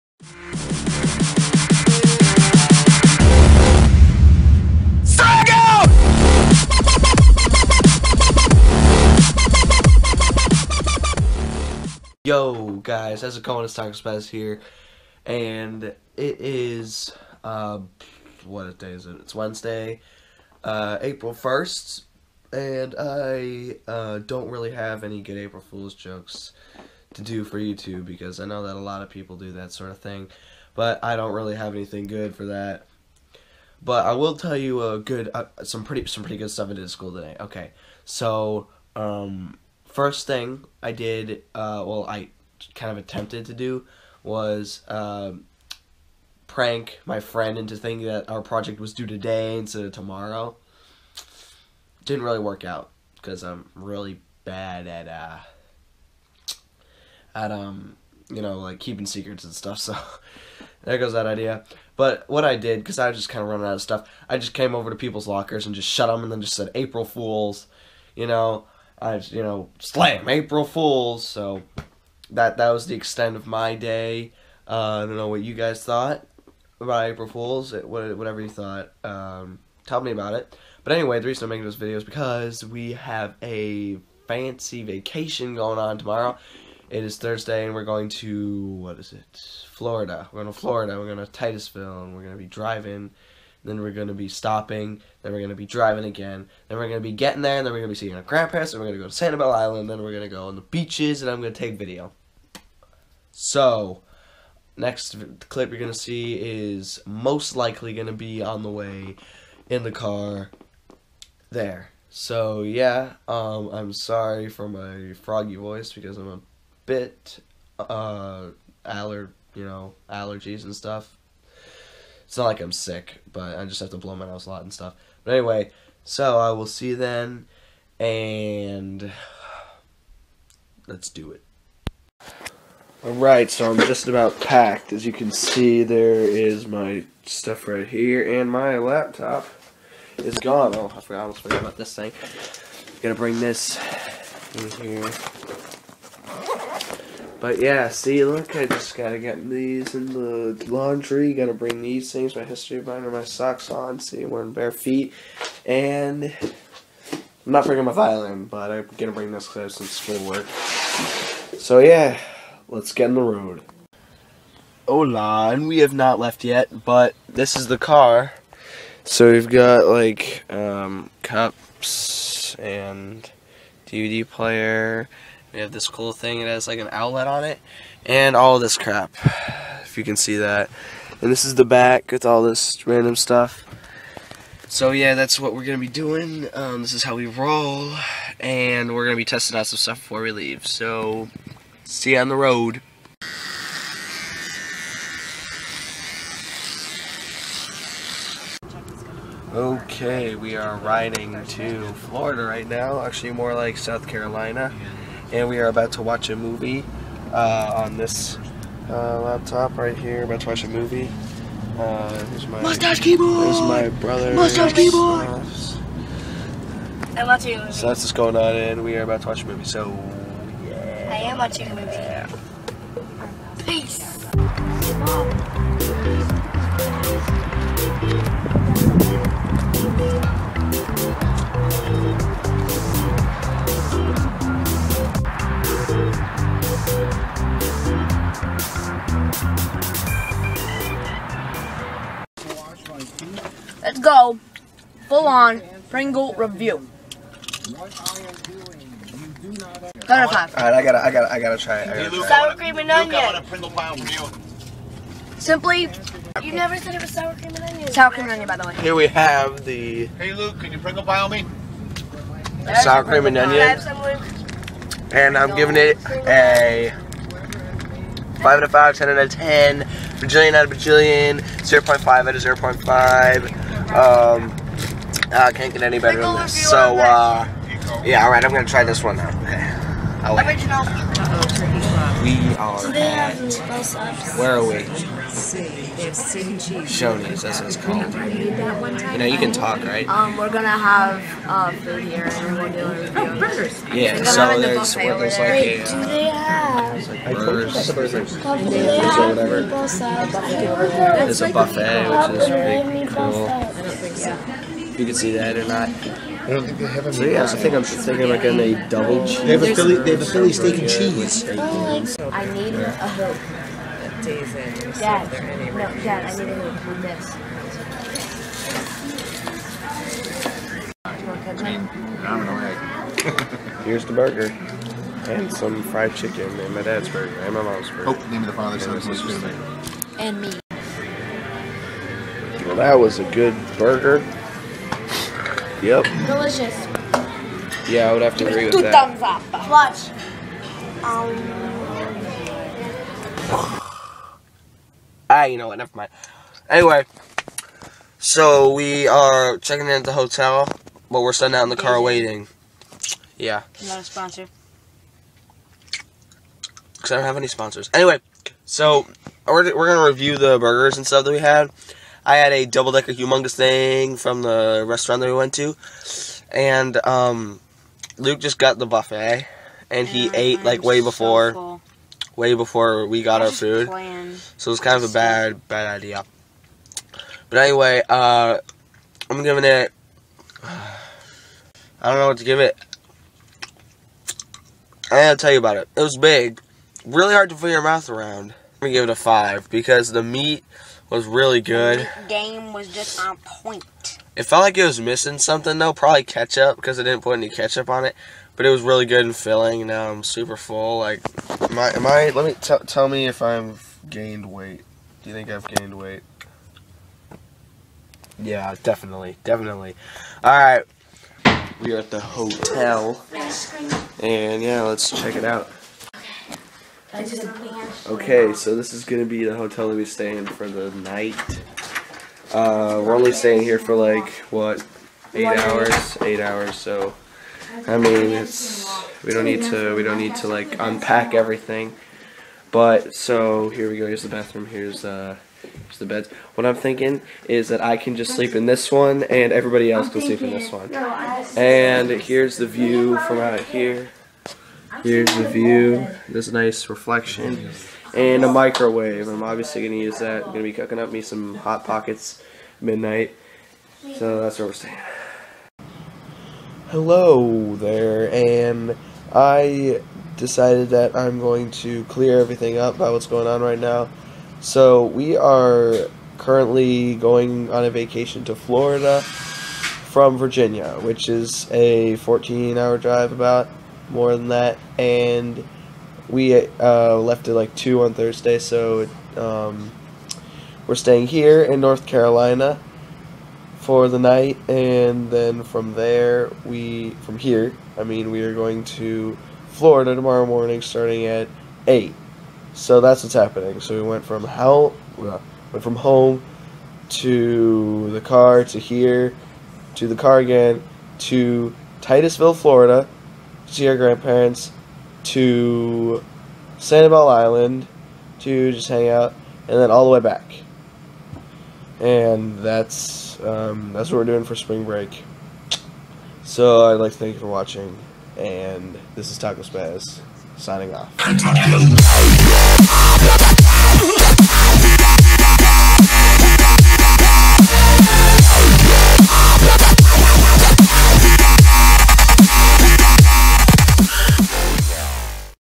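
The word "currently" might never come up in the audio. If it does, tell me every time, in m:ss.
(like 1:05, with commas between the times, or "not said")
7:46.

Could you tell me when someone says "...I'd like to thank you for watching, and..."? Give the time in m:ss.
8:36.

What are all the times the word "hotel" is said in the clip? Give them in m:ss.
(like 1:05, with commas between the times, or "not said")
5:50, 6:52, 6:59.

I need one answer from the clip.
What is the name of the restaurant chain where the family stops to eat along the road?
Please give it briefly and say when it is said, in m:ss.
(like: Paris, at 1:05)
Shoney's, at 4:46.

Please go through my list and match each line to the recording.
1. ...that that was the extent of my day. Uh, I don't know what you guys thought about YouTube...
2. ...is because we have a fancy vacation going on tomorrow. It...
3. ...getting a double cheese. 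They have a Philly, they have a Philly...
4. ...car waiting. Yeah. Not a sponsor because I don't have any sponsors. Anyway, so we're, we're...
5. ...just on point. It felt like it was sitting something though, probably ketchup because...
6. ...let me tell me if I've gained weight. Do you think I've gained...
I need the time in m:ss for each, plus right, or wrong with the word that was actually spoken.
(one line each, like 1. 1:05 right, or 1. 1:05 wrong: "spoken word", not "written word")
1. 1:12 wrong: "April", not "YouTube"
2. 1:21 right
3. 5:08 right
4. 5:51 right
5. 6:32 wrong: "missing", not "sitting"
6. 6:42 right.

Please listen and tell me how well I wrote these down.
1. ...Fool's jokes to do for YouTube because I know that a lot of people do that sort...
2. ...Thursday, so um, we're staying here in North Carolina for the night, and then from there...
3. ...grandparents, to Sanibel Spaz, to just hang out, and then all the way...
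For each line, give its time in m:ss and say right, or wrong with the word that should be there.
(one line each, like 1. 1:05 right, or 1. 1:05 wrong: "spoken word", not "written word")
1. 0:25 right
2. 7:58 right
3. 8:23 wrong: "Island", not "Spaz".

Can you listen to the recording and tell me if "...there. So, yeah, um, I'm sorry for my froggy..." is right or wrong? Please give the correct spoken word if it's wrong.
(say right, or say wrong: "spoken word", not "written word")
right.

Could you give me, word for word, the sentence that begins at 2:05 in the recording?
But anyway, so I will see you then, and let's do it.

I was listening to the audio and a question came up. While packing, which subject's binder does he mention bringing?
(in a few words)
History.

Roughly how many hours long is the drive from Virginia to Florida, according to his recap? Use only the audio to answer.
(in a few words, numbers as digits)
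14.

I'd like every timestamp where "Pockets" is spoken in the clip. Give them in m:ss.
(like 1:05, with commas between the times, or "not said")
7:31.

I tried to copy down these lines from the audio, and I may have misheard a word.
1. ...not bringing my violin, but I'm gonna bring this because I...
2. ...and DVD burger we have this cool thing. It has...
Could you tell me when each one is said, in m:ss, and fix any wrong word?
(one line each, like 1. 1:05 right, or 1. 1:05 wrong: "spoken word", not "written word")
1. 2:37 right
2. 2:52 wrong: "player", not "burger".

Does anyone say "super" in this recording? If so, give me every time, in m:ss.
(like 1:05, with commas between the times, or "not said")
6:40.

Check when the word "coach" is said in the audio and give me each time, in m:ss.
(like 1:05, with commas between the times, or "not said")
not said.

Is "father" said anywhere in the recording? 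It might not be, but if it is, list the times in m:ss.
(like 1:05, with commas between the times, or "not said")
5:28.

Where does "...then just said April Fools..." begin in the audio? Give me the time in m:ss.
1:06.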